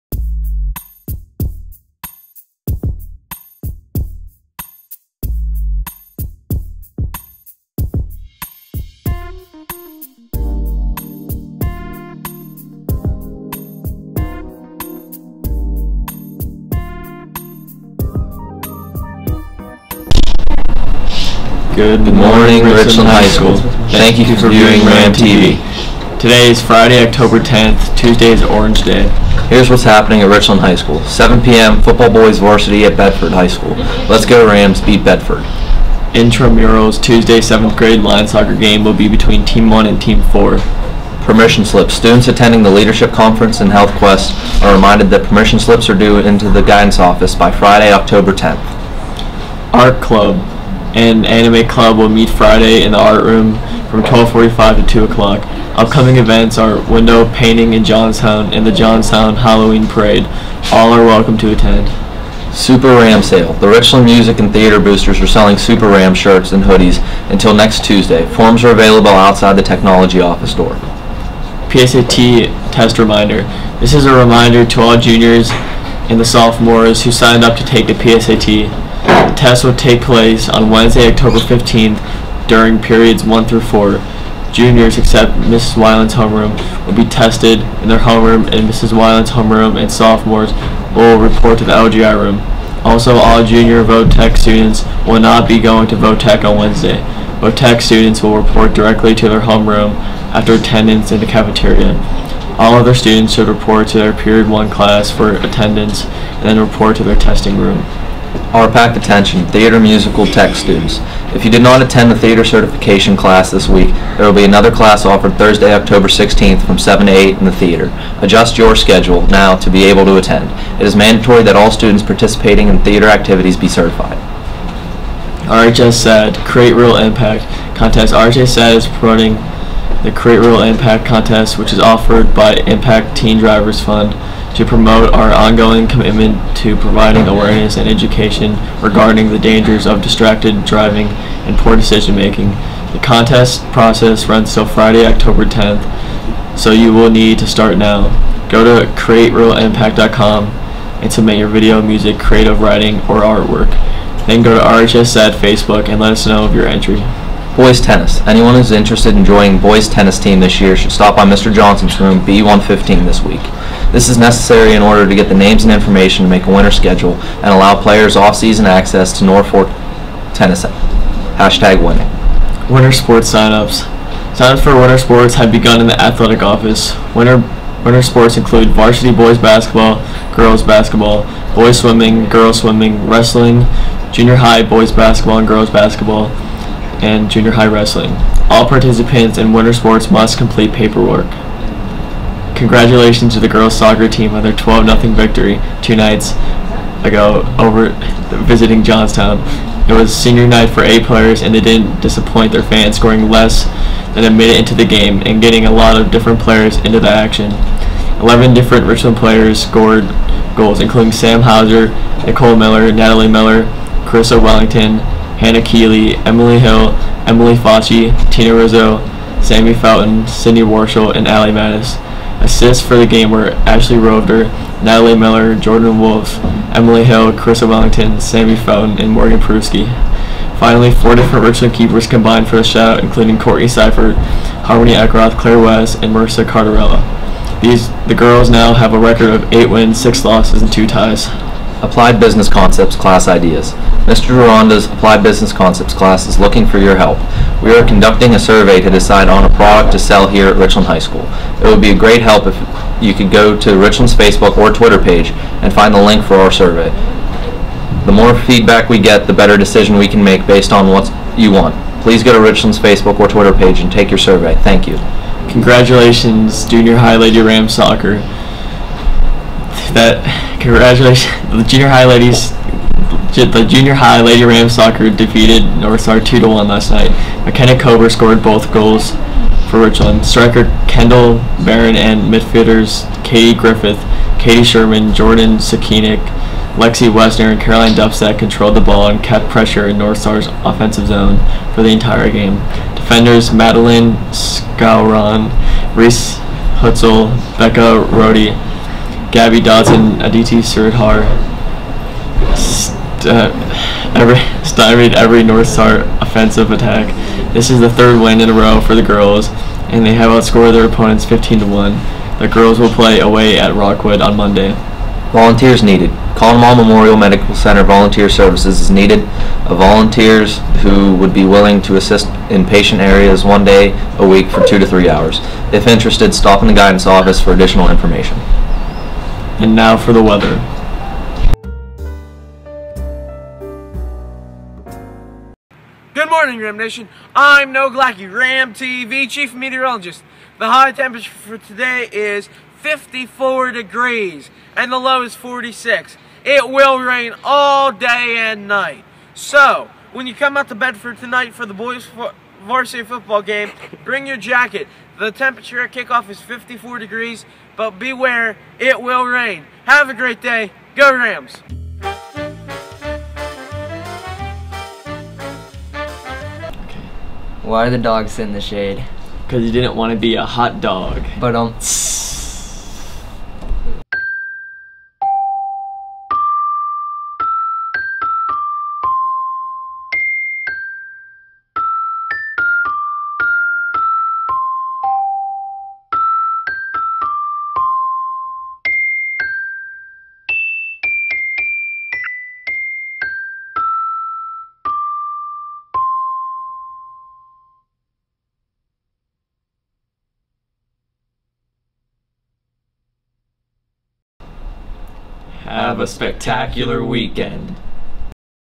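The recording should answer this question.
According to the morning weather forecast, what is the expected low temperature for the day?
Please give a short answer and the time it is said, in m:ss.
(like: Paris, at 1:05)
46 degrees, at 5:45.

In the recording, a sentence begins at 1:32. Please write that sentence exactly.
Also, all junior VOTEC students will not be going to VOTEC on Wednesday.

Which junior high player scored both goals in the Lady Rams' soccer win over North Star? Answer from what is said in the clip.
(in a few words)
McKenna Cober.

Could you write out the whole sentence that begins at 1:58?
Adjust your schedule now to be able to attend.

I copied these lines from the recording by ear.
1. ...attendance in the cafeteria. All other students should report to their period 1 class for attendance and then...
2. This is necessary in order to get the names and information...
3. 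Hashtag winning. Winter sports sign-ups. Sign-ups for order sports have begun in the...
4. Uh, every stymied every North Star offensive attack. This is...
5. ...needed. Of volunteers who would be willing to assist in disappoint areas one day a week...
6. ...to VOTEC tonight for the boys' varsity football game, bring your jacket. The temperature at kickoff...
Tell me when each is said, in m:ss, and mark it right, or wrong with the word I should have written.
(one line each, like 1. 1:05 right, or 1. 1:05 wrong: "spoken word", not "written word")
1. 1:40 right
2. 2:43 right
3. 2:50 wrong: "winter", not "order"
4. 5:03 right
5. 5:18 wrong: "patient", not "disappoint"
6. 5:50 wrong: "Bedford", not "VOTEC".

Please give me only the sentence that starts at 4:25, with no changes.
Congratulations, Junior High Lady Ram Soccer.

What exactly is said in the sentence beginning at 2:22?
The contest process runs till Friday, October 10th, so you will need to start now.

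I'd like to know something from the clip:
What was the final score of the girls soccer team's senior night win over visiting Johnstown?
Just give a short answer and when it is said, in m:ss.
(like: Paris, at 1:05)
12-0, at 3:14.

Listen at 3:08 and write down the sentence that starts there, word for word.
All participants in winter sports must complete paperwork.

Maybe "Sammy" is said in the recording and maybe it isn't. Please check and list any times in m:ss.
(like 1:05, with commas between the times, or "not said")
3:39, 3:48.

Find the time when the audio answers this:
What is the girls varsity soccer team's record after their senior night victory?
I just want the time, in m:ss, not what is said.
3:59.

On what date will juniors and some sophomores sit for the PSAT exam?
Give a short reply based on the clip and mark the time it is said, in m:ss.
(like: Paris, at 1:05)
Wednesday, October 15th, at 1:20.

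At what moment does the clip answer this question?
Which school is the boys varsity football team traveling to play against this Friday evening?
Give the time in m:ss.
0:32.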